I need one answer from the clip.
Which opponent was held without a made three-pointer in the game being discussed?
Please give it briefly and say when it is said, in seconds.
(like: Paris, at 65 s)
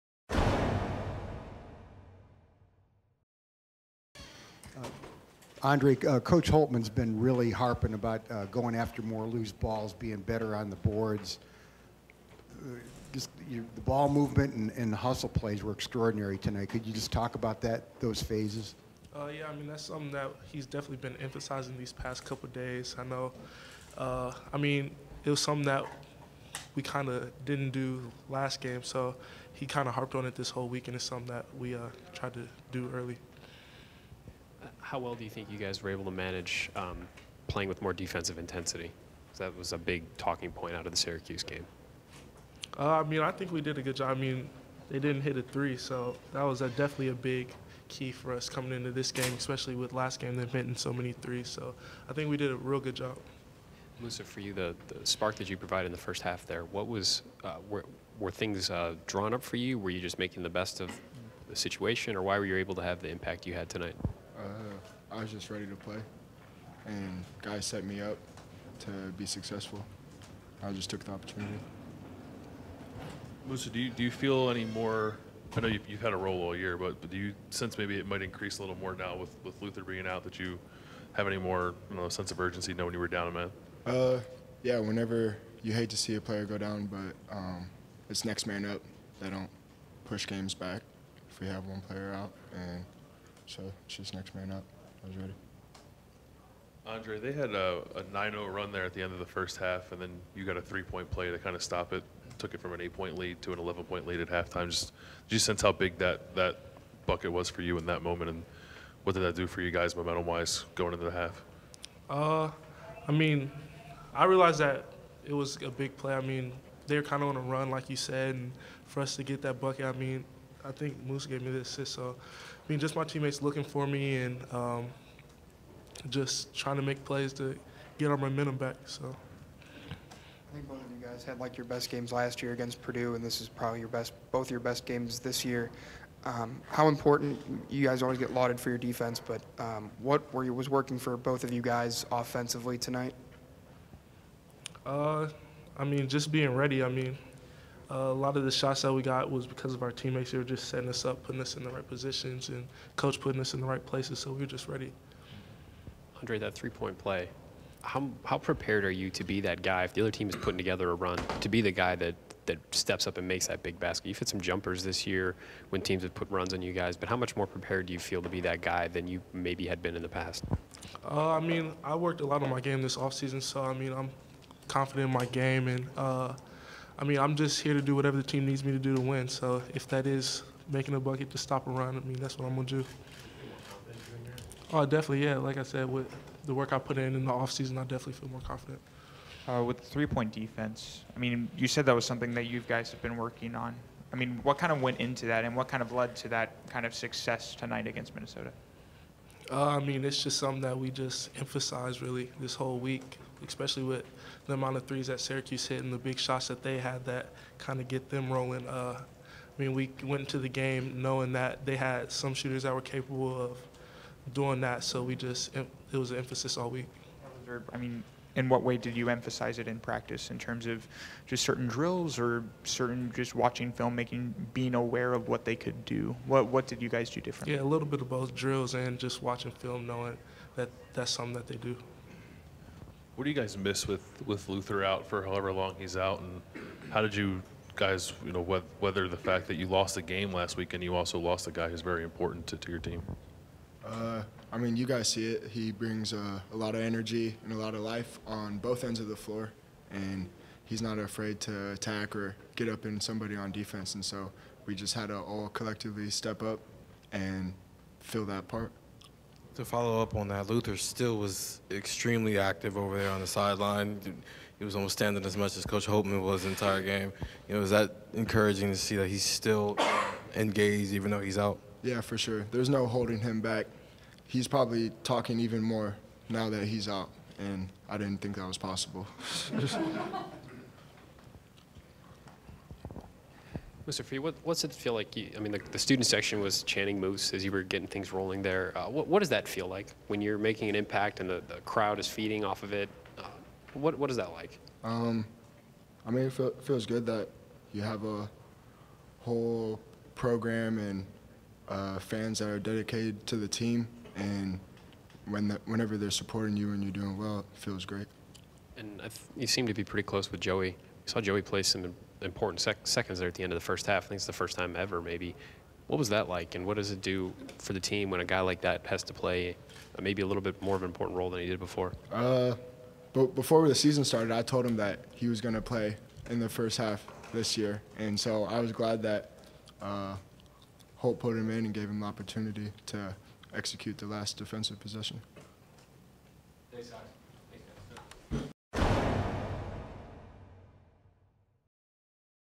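Minnesota, at 198 s.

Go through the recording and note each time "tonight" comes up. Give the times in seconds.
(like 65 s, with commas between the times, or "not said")
16 s, 63 s, 142 s, 197 s.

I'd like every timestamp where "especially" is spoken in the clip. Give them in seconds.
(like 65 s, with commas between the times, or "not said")
49 s, 203 s.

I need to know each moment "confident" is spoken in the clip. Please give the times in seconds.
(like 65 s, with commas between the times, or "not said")
174 s, 188 s.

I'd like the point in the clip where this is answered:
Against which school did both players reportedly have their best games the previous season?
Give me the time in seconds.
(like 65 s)
132 s.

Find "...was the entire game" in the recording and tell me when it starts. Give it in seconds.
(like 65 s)
266 s.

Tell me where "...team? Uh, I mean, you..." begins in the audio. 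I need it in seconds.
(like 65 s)
242 s.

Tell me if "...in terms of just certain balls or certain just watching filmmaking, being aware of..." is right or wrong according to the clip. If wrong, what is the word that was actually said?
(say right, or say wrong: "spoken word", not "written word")
wrong: "drills", not "balls".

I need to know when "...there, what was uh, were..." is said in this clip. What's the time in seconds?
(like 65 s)
56 s.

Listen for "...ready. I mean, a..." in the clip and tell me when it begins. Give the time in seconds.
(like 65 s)
146 s.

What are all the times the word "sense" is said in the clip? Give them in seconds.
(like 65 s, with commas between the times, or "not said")
77 s, 82 s, 105 s.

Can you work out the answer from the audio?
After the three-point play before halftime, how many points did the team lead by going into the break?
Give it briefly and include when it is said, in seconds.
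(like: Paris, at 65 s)
11 points, at 103 s.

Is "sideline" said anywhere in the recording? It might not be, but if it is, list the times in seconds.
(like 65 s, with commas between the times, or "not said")
263 s.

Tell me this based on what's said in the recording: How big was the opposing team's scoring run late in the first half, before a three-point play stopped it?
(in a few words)
9-0.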